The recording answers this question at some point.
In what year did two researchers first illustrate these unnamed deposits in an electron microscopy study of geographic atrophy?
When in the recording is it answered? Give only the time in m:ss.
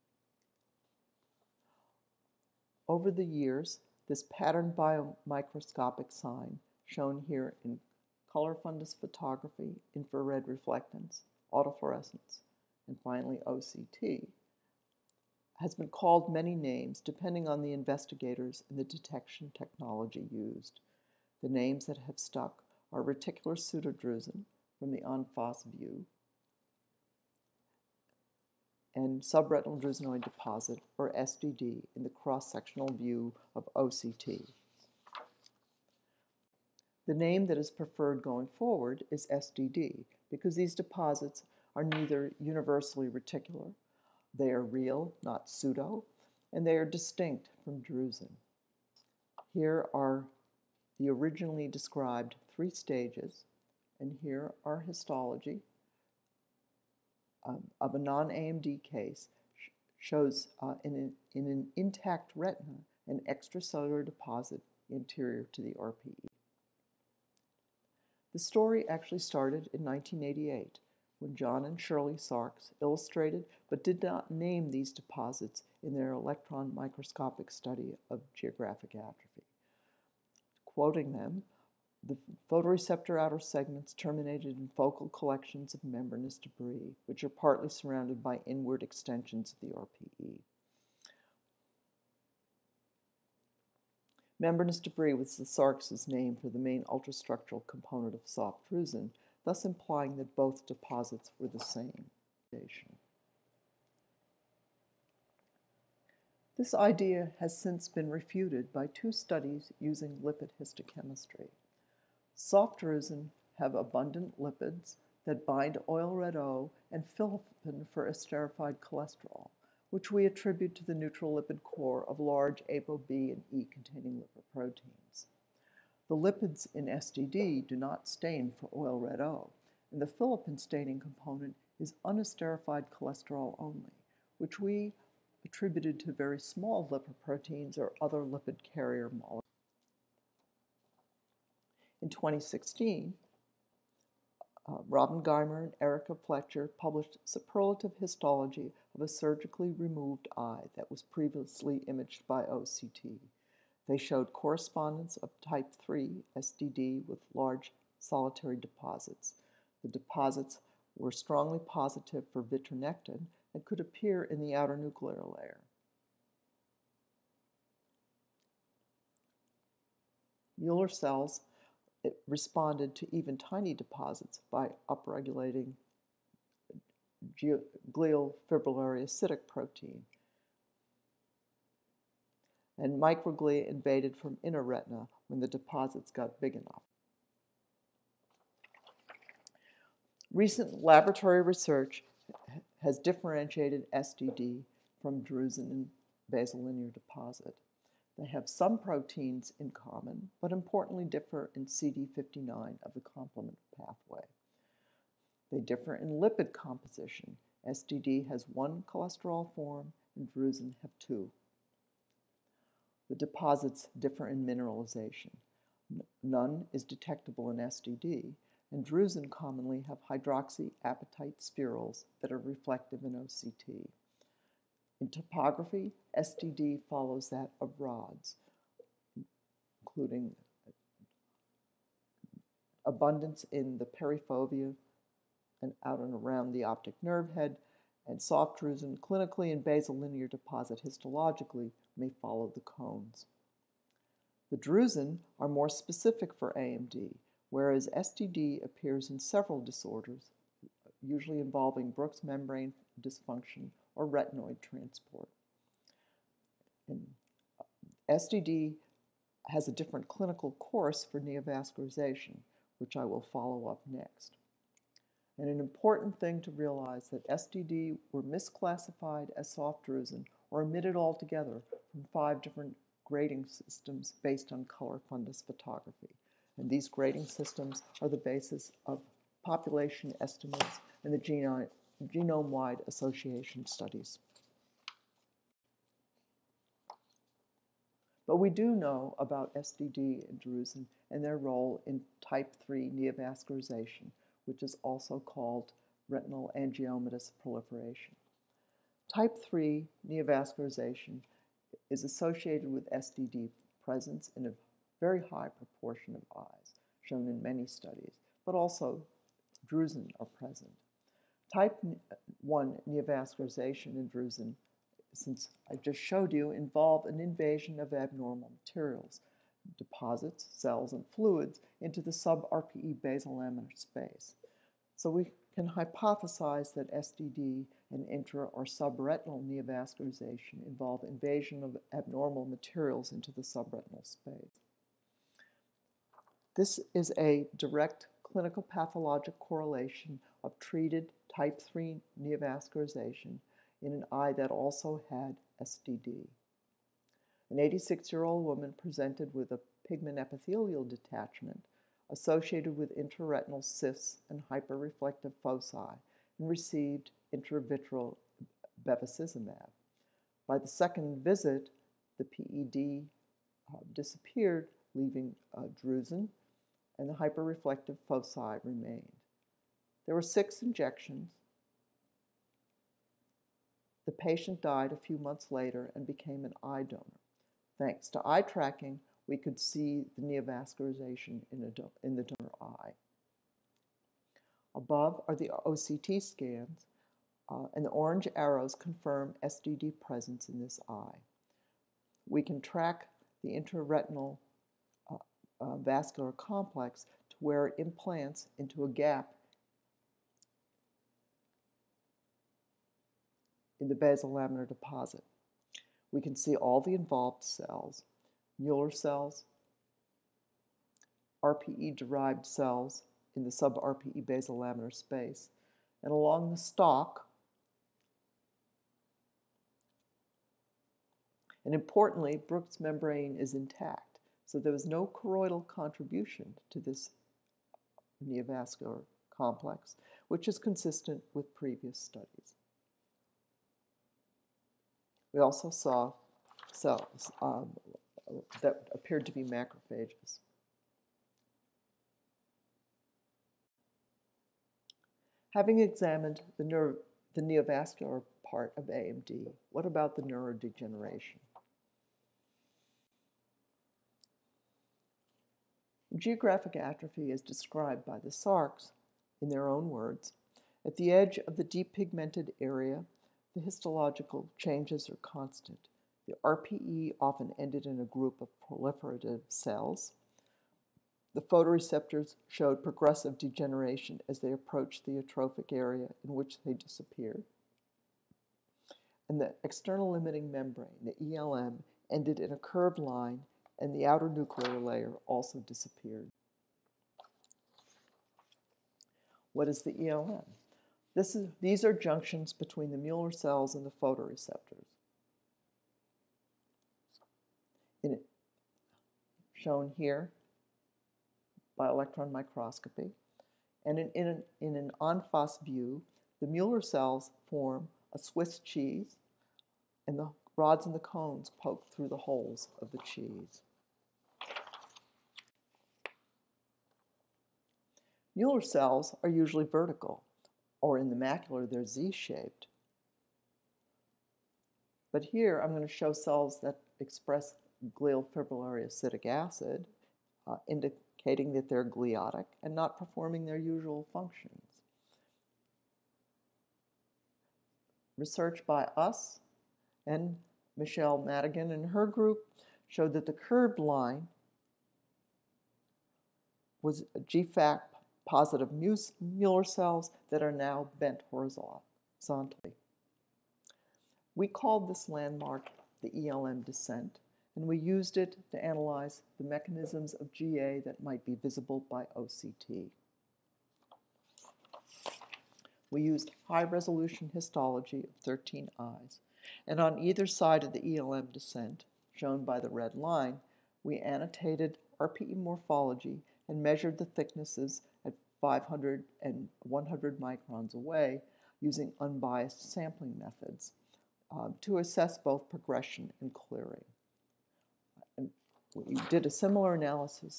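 1:09.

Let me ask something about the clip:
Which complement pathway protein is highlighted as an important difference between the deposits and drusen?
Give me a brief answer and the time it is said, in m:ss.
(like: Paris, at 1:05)
CD59, at 3:21.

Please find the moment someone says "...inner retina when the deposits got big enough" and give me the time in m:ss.
3:04.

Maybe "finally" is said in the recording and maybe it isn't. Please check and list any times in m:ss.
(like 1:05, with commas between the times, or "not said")
0:13.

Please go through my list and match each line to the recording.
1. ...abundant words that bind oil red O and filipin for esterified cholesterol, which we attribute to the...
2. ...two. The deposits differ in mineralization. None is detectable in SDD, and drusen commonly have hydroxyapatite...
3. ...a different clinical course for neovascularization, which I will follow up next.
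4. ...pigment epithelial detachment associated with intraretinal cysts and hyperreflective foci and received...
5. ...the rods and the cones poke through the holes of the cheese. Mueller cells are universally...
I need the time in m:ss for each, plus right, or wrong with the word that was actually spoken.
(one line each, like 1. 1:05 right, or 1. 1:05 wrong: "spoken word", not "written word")
1. 1:53 wrong: "lipids", not "words"
2. 3:30 right
3. 4:19 right
4. 5:49 right
5. 8:30 wrong: "usually", not "universally".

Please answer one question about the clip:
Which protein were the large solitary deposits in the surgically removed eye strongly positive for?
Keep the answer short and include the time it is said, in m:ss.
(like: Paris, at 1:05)
Vitronectin, at 2:42.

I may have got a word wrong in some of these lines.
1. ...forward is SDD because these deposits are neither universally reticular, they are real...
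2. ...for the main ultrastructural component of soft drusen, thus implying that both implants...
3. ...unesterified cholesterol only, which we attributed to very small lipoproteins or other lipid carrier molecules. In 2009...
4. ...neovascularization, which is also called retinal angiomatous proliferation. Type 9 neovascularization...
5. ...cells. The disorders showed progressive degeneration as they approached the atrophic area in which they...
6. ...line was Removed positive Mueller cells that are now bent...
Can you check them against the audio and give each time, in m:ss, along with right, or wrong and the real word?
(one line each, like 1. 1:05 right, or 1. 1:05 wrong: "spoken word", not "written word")
1. 0:38 right
2. 1:36 wrong: "deposits", not "implants"
3. 2:12 wrong: "2016", not "2009"
4. 4:52 wrong: "3", not "9"
5. 7:49 wrong: "photoreceptors", not "disorders"
6. 9:03 wrong: "GFAP", not "Removed".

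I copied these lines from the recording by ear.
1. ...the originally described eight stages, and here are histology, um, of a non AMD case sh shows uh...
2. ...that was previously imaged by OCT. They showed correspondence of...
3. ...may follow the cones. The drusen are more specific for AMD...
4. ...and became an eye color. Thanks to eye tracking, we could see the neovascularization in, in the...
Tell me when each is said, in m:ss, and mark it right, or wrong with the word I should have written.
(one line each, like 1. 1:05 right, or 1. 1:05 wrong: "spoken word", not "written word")
1. 0:50 wrong: "three", not "eight"
2. 2:30 right
3. 4:01 right
4. 6:15 wrong: "donor", not "color".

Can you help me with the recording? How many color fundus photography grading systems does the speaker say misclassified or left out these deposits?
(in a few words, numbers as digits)
5.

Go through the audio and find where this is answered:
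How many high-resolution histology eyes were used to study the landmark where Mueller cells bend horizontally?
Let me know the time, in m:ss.
9:28.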